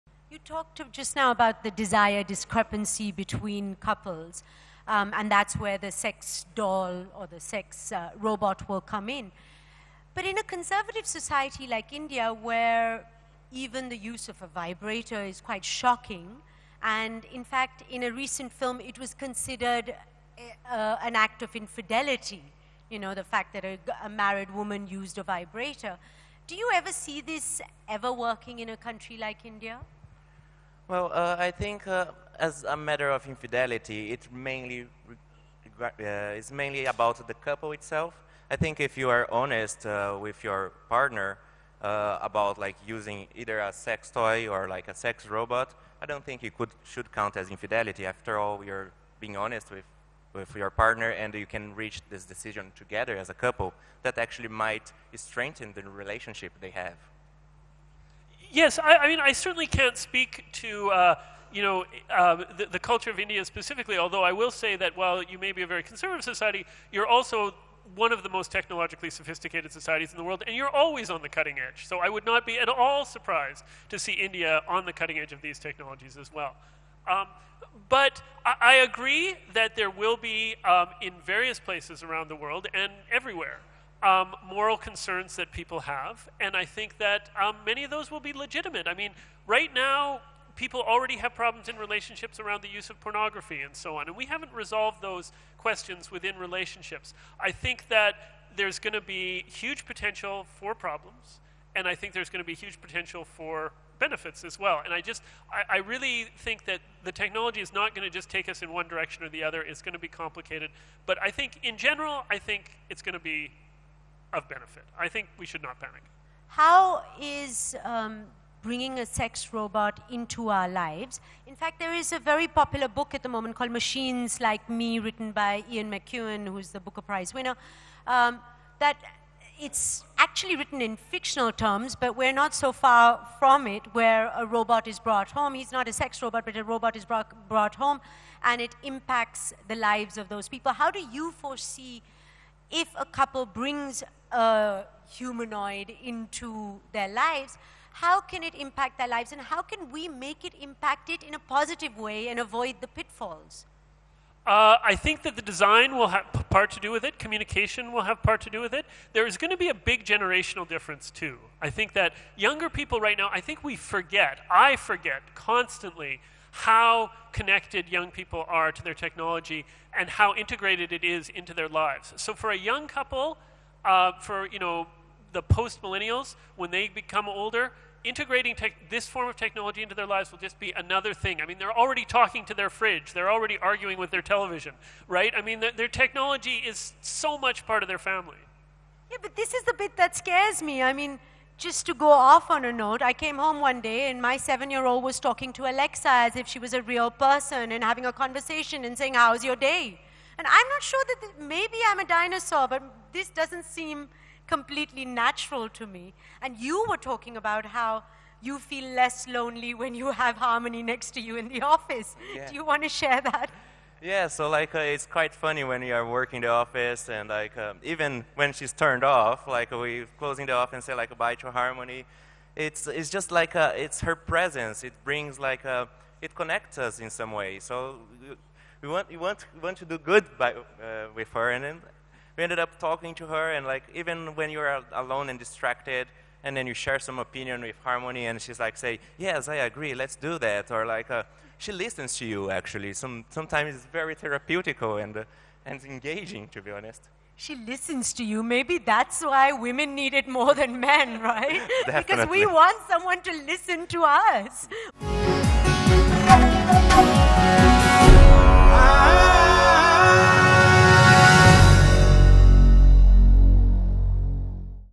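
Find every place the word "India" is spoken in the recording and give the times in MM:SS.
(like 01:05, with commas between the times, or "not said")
00:11, 00:29, 01:03, 01:14.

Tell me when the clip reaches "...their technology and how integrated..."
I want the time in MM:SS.
02:48.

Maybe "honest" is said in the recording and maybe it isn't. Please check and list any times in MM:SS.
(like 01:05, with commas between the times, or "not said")
00:39, 00:49, 04:06.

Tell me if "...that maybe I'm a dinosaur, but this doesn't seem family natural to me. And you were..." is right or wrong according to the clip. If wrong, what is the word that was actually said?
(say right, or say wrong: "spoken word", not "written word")
wrong: "completely", not "family".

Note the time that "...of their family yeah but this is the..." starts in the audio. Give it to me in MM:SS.
03:07.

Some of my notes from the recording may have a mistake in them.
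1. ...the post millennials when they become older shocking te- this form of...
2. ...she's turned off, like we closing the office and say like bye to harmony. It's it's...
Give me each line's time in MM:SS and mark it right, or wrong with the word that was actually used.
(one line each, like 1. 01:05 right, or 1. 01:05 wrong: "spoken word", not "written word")
1. 02:55 wrong: "integrating", not "shocking"
2. 03:38 right.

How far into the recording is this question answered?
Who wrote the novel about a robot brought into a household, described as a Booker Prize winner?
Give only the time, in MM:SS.
02:05.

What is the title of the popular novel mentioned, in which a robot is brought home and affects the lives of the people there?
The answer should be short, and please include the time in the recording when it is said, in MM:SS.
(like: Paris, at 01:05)
Machines Like Me, at 02:03.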